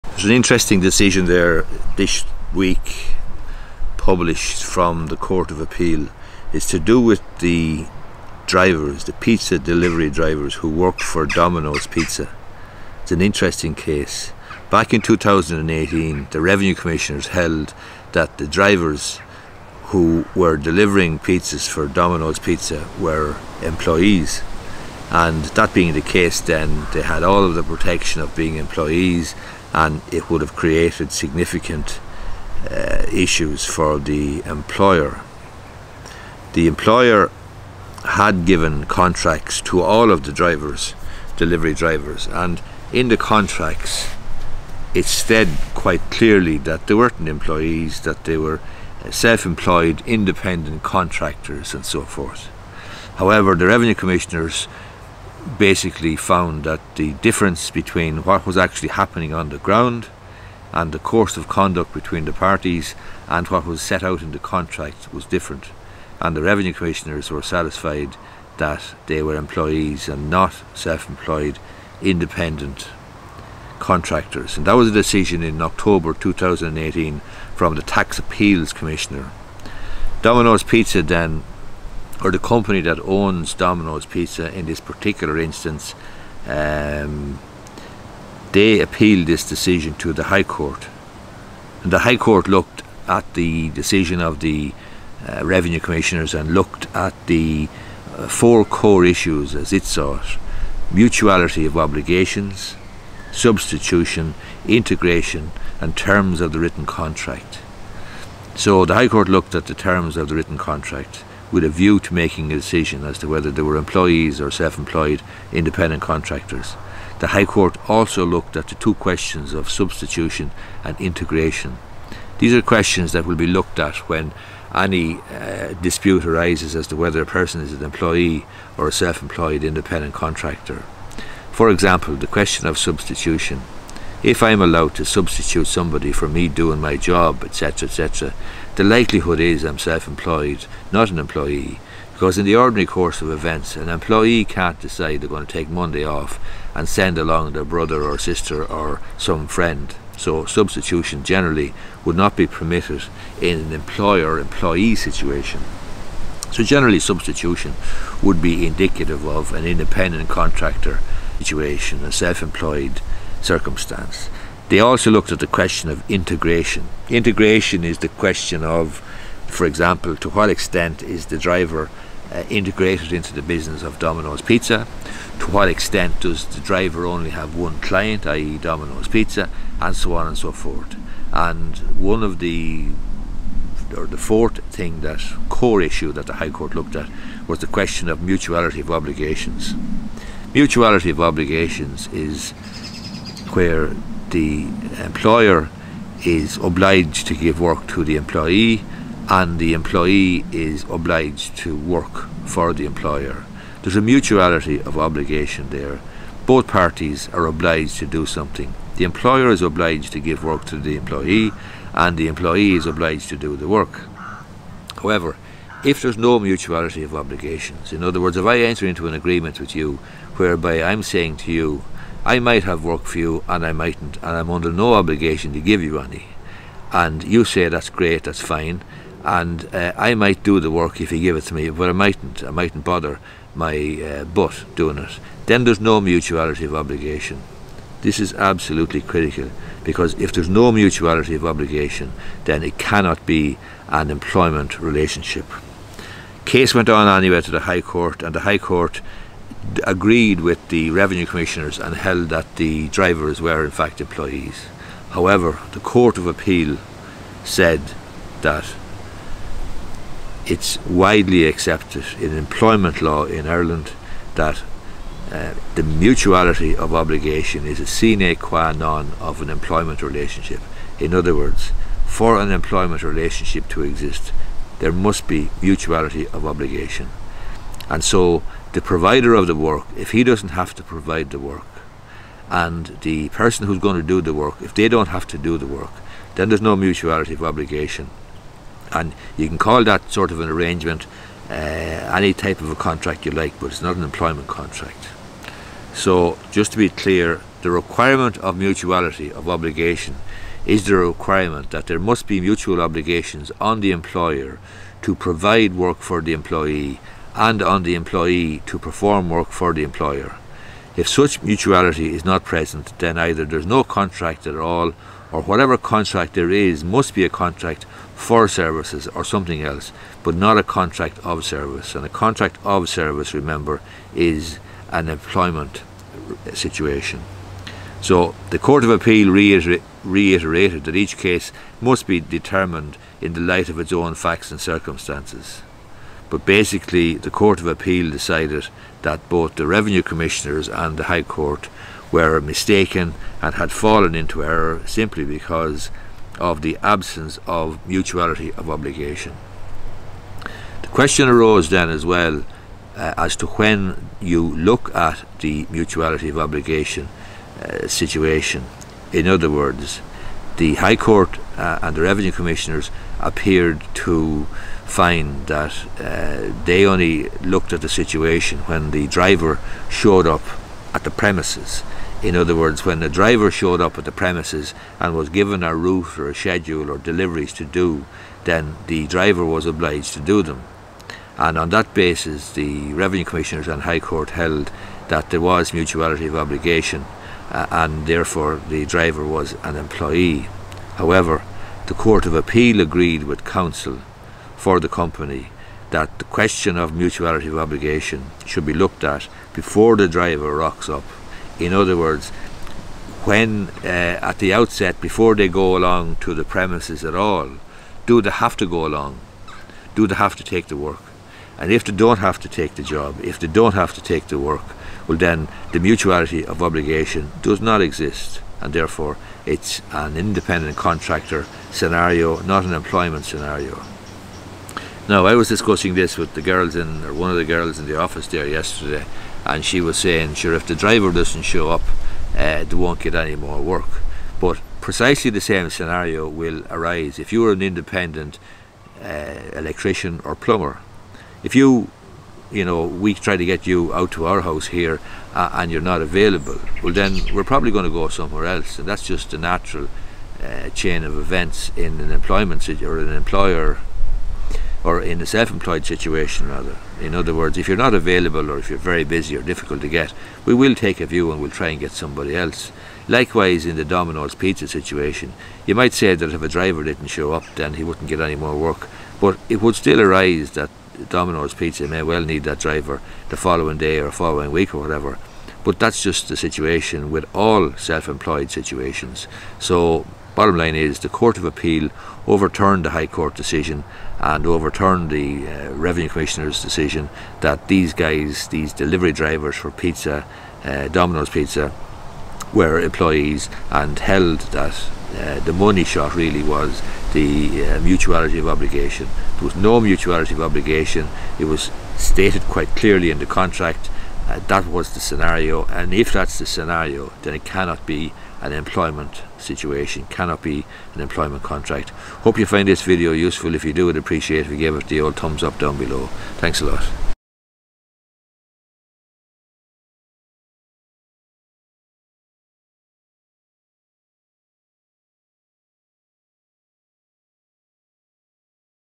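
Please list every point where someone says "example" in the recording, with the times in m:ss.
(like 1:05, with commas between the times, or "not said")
2:11, 2:49.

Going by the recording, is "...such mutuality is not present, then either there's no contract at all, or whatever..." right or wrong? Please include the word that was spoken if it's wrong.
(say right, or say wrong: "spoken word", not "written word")
right.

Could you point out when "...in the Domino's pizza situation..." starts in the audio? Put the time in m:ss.
7:43.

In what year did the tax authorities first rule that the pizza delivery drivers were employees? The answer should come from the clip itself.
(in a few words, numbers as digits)
2018.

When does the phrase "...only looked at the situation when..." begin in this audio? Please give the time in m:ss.
6:06.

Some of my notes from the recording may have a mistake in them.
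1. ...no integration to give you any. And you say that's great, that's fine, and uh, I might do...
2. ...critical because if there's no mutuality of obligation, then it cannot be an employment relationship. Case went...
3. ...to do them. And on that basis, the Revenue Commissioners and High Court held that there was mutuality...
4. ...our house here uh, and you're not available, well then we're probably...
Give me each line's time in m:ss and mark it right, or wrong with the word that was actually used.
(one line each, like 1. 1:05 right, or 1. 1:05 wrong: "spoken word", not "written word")
1. 3:44 wrong: "obligation", not "integration"
2. 3:59 right
3. 6:20 right
4. 7:24 right.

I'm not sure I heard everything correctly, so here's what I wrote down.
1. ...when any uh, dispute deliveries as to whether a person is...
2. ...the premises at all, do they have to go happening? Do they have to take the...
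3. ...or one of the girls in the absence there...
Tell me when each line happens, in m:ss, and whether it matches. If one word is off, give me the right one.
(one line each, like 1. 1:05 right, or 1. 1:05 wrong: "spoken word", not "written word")
1. 2:04 wrong: "arises", not "deliveries"
2. 6:46 wrong: "along", not "happening"
3. 7:07 wrong: "office", not "absence".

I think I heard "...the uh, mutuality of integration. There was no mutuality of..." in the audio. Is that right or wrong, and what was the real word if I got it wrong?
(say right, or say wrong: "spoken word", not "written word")
wrong: "obligation", not "integration".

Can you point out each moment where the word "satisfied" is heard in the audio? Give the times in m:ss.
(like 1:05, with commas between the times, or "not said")
1:07.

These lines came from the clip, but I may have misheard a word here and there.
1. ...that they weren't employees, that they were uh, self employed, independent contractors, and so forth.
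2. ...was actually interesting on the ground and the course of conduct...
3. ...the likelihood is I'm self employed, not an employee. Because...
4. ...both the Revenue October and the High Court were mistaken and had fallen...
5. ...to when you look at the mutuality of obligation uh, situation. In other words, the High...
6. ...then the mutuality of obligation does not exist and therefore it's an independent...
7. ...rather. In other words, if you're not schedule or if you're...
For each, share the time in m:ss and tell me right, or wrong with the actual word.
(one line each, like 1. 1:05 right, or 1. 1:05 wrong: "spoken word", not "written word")
1. 0:46 right
2. 0:58 wrong: "happening", not "interesting"
3. 2:18 right
4. 5:39 wrong: "Commissioners", not "October"
5. 5:53 right
6. 6:55 right
7. 7:36 wrong: "available", not "schedule".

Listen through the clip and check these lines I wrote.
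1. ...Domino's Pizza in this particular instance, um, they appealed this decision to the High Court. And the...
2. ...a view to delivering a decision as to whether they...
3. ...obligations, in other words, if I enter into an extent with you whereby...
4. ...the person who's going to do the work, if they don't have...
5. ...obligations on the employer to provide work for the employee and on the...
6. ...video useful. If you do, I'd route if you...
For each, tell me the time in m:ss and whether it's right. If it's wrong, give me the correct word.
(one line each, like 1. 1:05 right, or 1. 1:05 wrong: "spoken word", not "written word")
1. 1:23 right
2. 1:51 wrong: "making", not "delivering"
3. 3:37 wrong: "agreement", not "extent"
4. 4:43 right
5. 5:02 right
6. 8:32 wrong: "appreciate", not "route".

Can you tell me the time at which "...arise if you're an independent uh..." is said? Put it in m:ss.
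7:16.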